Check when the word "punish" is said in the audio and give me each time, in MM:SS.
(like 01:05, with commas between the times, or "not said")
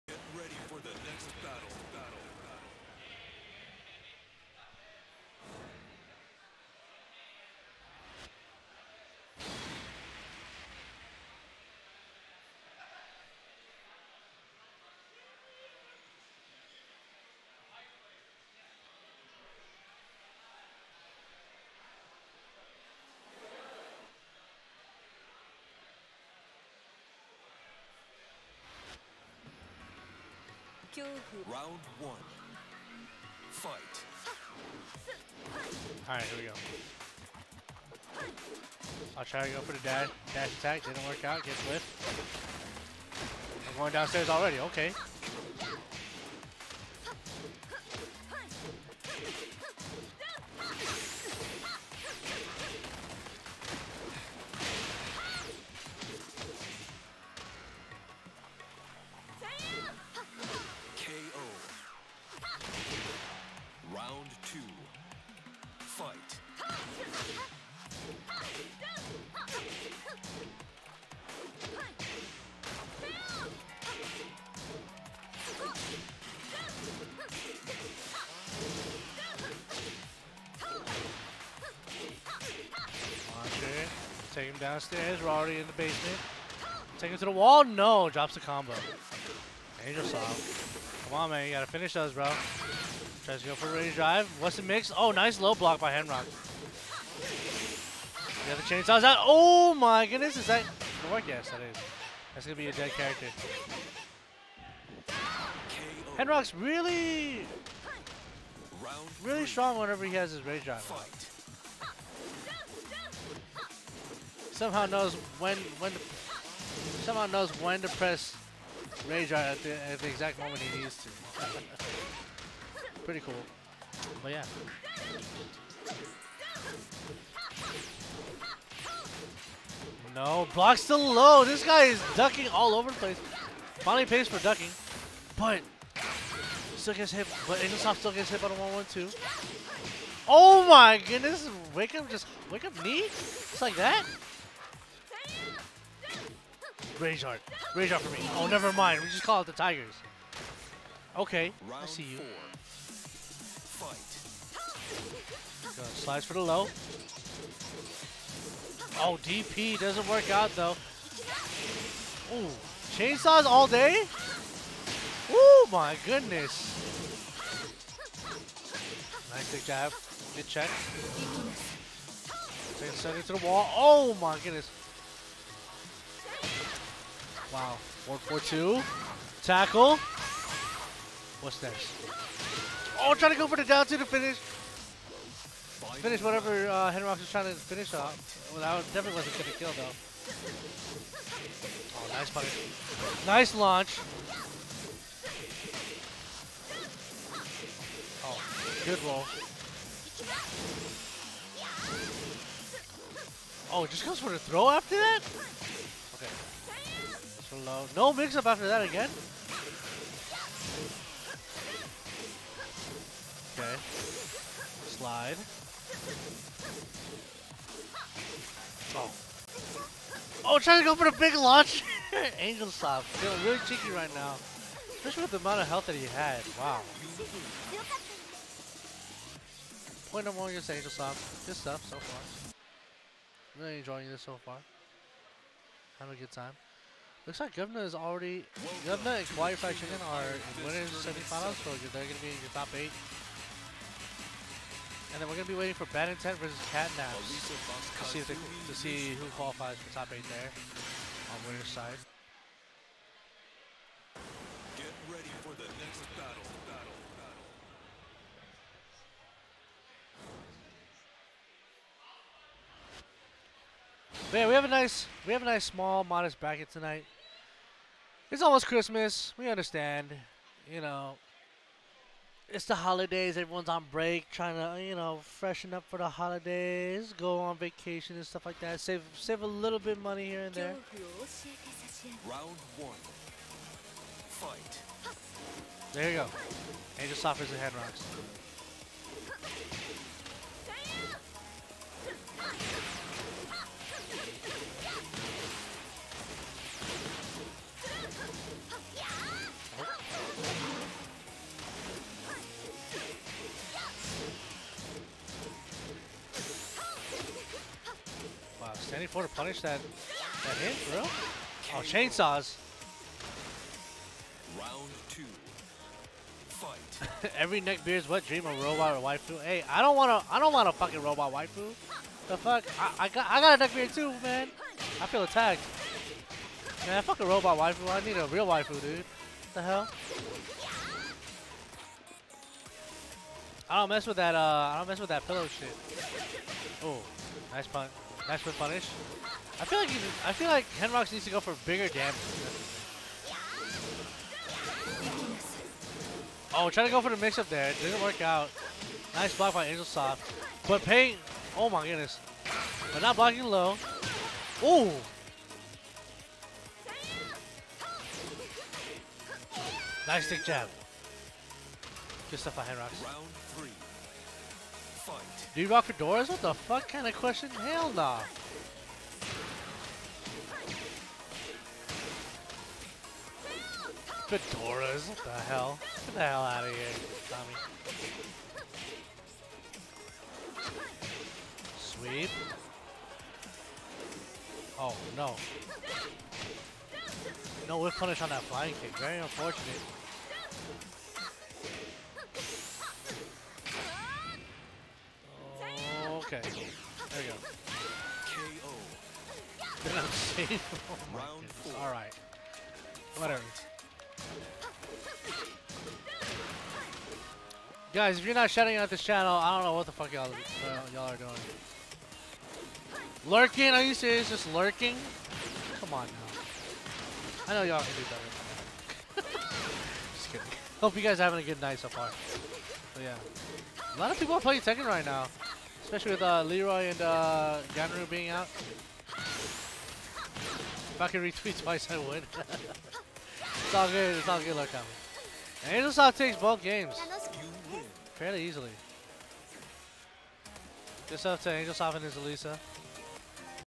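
03:12, 05:09, 05:38, 06:27.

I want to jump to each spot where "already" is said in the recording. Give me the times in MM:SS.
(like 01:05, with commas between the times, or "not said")
00:44, 01:25, 03:57.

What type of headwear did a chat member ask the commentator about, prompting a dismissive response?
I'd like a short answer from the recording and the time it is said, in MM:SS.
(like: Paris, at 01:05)
Fedoras, at 06:14.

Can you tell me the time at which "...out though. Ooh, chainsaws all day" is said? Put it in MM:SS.
02:40.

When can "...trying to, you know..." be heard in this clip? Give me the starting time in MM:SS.
04:34.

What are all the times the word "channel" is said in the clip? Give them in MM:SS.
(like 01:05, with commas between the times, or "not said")
06:49.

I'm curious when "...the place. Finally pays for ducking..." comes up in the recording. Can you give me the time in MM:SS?
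02:12.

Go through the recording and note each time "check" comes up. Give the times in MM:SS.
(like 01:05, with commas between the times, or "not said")
02:50.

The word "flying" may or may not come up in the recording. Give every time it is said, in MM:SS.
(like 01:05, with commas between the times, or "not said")
06:28.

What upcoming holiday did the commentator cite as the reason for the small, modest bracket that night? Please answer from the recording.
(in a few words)
Christmas.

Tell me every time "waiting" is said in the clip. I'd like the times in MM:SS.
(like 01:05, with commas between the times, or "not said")
04:05.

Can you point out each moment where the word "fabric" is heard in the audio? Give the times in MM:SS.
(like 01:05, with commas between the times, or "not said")
not said.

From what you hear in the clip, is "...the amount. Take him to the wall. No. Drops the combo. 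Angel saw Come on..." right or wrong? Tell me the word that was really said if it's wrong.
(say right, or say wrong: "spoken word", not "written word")
wrong: "basement", not "amount".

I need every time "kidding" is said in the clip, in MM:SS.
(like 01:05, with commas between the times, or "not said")
07:00.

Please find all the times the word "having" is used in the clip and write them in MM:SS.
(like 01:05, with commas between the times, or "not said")
03:55, 07:01.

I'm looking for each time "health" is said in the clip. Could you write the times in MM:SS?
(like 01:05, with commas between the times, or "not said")
03:45.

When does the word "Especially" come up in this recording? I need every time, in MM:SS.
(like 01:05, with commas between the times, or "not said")
03:44, 07:05.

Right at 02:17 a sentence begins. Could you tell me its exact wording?
But Angelsoft still gets hit by the 112.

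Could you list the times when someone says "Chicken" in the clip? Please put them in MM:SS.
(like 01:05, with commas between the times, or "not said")
03:59.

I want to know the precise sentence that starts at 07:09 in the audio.
If I could retweet twice, I would.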